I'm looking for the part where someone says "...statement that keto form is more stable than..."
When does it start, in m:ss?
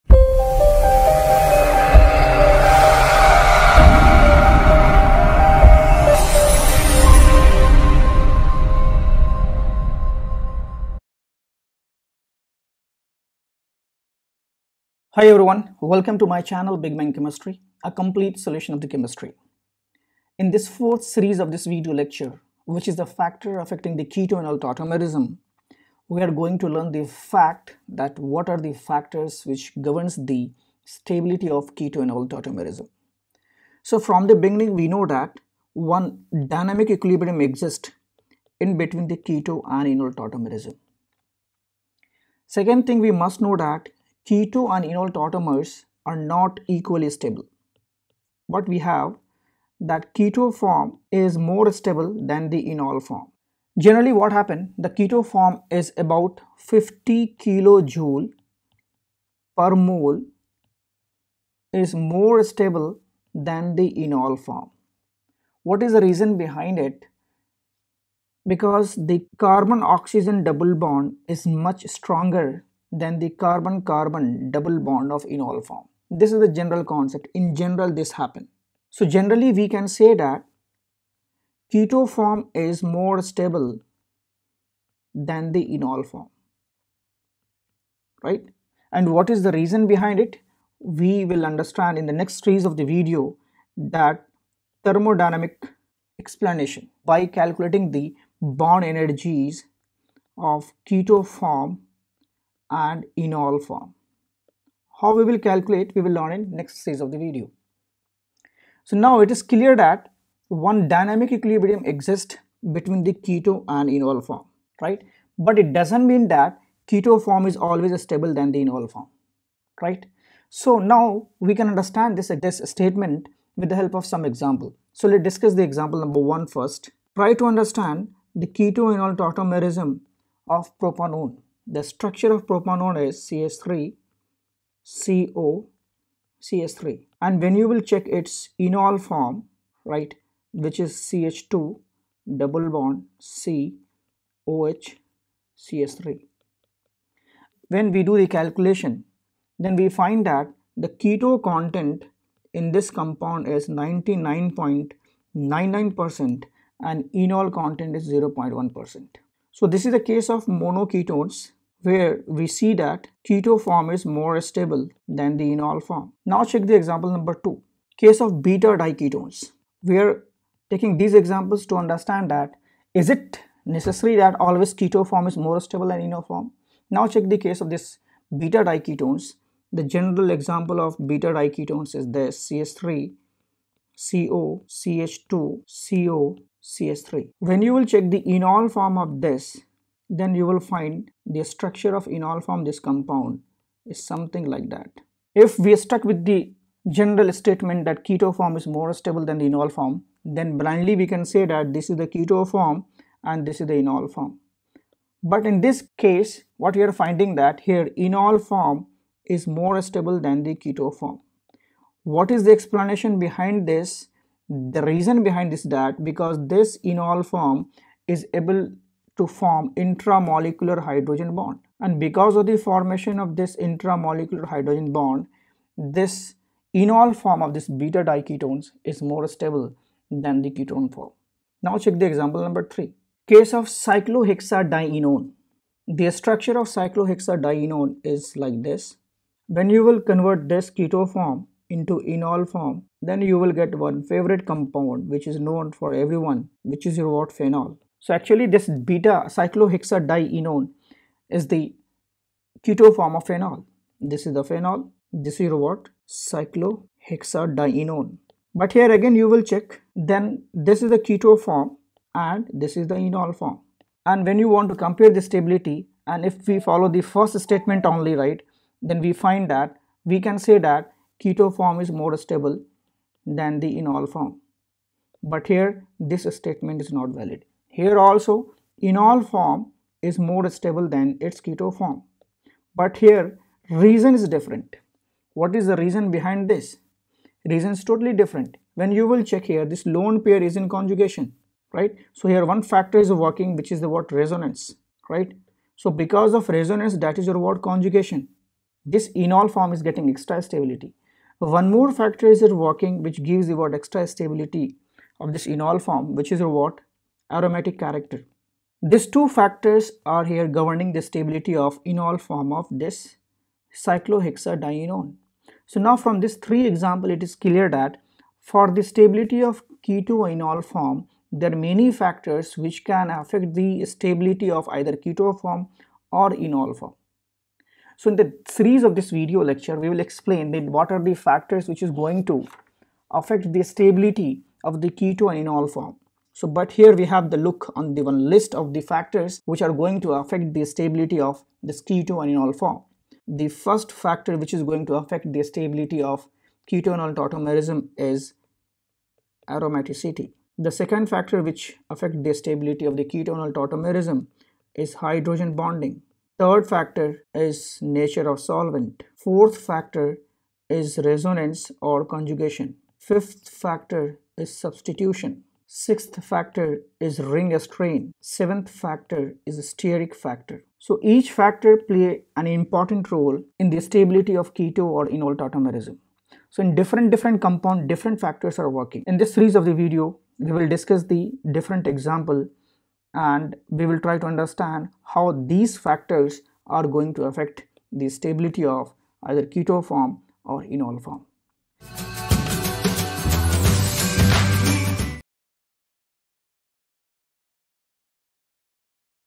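3:17.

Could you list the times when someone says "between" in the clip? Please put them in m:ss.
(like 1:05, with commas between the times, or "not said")
0:38, 1:52.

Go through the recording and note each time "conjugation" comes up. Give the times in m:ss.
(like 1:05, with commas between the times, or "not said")
4:50, 4:57, 6:02.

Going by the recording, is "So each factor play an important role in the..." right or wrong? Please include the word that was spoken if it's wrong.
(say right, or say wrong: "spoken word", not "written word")
right.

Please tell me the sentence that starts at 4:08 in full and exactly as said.
So actually this beta cyclohexadienone is the keto form of phenol.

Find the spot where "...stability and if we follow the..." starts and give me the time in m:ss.
4:25.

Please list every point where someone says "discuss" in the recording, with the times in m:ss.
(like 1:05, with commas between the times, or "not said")
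2:05, 6:20.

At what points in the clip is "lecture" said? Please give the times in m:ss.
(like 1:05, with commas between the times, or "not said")
0:21, 5:29.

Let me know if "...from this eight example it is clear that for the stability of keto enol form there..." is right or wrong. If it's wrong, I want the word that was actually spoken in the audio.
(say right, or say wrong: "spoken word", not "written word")
wrong: "three", not "eight".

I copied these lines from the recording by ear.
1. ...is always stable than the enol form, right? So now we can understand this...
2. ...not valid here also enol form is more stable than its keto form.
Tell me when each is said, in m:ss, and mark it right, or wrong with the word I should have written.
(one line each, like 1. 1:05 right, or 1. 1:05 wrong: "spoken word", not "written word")
1. 1:57 right
2. 4:36 right.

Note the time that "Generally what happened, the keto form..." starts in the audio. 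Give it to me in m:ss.
0:53.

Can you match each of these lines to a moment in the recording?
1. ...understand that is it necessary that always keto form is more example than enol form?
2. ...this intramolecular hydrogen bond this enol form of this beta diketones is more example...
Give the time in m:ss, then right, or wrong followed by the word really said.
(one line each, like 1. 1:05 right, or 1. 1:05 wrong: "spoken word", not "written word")
1. 2:51 wrong: "stable", not "example"
2. 3:43 wrong: "stable", not "example".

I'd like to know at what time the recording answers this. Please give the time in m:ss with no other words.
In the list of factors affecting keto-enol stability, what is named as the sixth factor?
6:07.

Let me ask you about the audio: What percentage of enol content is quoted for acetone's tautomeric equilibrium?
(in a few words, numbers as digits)
0.1%.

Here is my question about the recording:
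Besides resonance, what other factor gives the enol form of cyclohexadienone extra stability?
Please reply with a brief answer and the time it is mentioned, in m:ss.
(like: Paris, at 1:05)
aromatic character, at 5:07.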